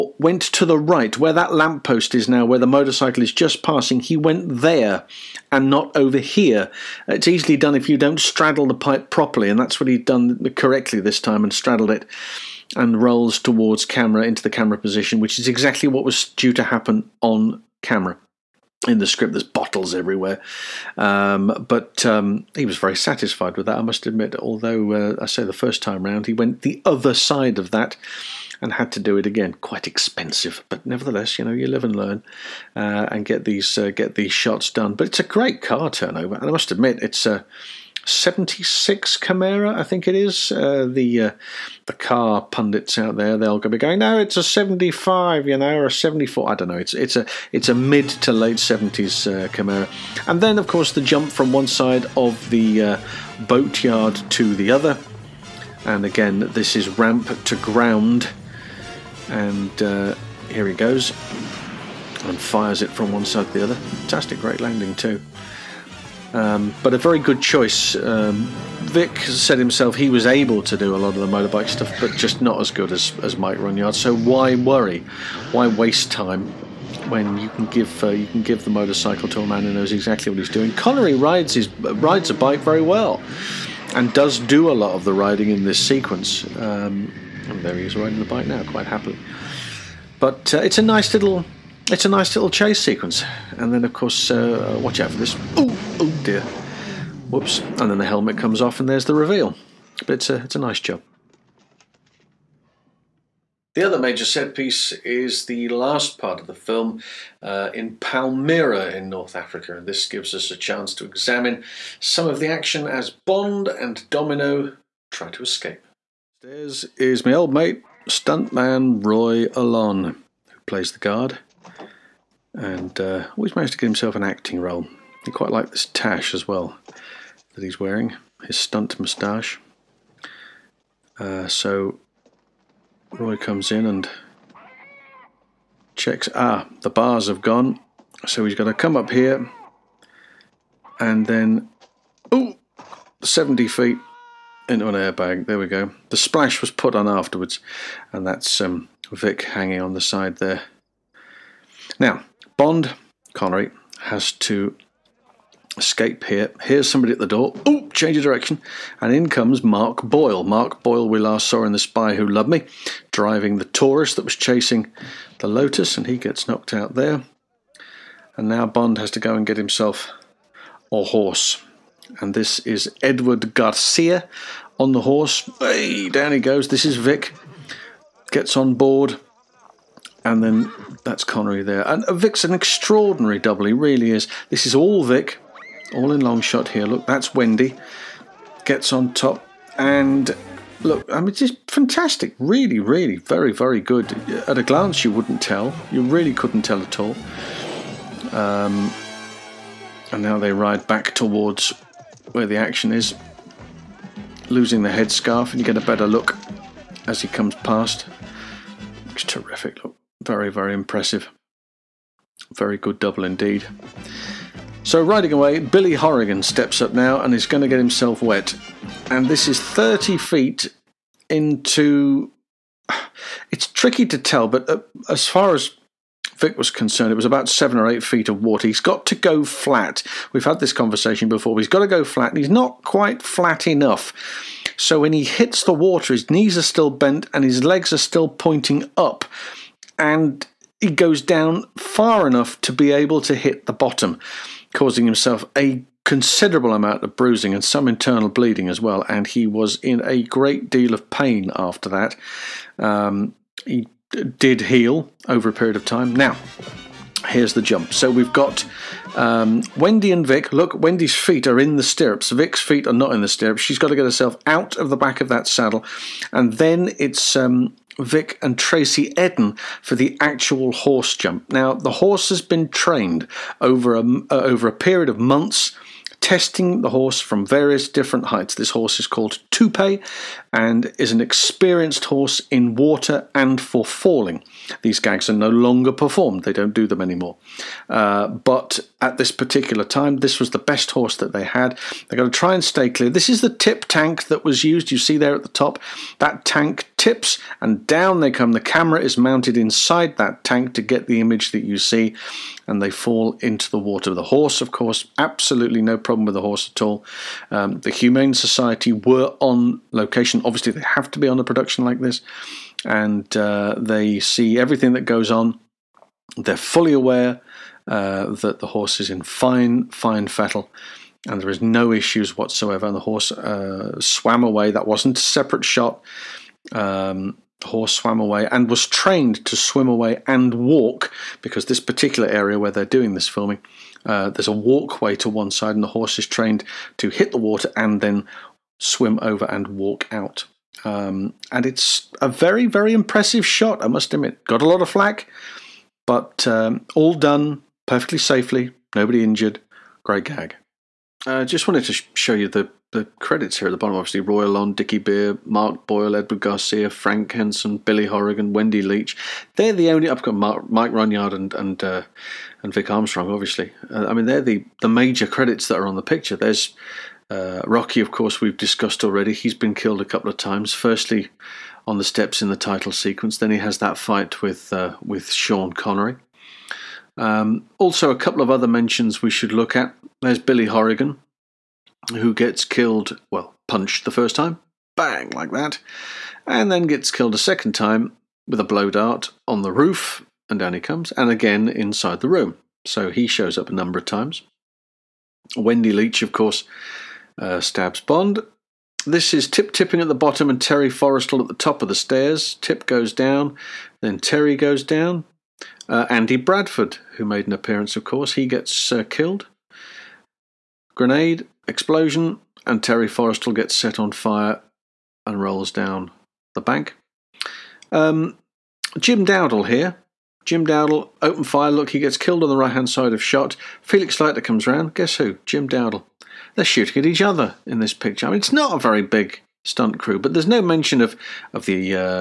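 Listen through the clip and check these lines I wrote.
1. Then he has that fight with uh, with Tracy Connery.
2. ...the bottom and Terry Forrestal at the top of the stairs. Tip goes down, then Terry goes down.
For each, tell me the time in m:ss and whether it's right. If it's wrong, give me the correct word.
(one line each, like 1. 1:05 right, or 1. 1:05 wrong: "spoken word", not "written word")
1. 6:13 wrong: "Sean", not "Tracy"
2. 6:40 right.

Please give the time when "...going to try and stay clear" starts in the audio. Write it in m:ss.
4:52.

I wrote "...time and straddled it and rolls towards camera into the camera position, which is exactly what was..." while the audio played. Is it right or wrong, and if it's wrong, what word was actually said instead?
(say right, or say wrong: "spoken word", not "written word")
right.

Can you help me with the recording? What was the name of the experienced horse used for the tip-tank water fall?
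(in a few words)
Toupe.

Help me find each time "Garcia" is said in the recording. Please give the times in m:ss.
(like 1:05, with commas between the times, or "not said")
2:53, 5:56.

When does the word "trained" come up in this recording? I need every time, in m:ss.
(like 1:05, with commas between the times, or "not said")
4:32, 5:28, 5:36.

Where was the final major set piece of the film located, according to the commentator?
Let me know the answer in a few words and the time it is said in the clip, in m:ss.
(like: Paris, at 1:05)
Palmyra, at 1:47.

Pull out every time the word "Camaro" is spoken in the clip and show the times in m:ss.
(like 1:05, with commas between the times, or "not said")
0:39, 0:49.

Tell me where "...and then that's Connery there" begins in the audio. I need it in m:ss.
3:00.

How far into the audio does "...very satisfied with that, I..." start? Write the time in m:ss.
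0:22.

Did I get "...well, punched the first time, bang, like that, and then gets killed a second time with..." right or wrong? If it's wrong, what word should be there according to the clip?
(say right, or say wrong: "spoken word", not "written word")
right.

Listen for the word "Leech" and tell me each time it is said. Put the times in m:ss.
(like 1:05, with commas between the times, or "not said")
5:58, 6:35.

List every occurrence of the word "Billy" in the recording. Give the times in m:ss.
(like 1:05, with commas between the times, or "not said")
3:35, 5:57, 6:20.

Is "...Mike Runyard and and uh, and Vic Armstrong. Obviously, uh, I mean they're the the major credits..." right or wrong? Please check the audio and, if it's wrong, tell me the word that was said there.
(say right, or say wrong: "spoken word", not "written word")
right.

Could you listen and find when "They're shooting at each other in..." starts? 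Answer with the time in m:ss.
7:06.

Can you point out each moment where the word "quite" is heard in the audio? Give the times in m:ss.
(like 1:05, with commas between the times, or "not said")
0:29, 1:28, 2:05, 3:52.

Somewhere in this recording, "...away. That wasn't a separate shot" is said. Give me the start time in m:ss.
5:24.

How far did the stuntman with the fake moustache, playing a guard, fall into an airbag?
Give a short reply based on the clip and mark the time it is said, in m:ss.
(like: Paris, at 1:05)
70 feet, at 2:23.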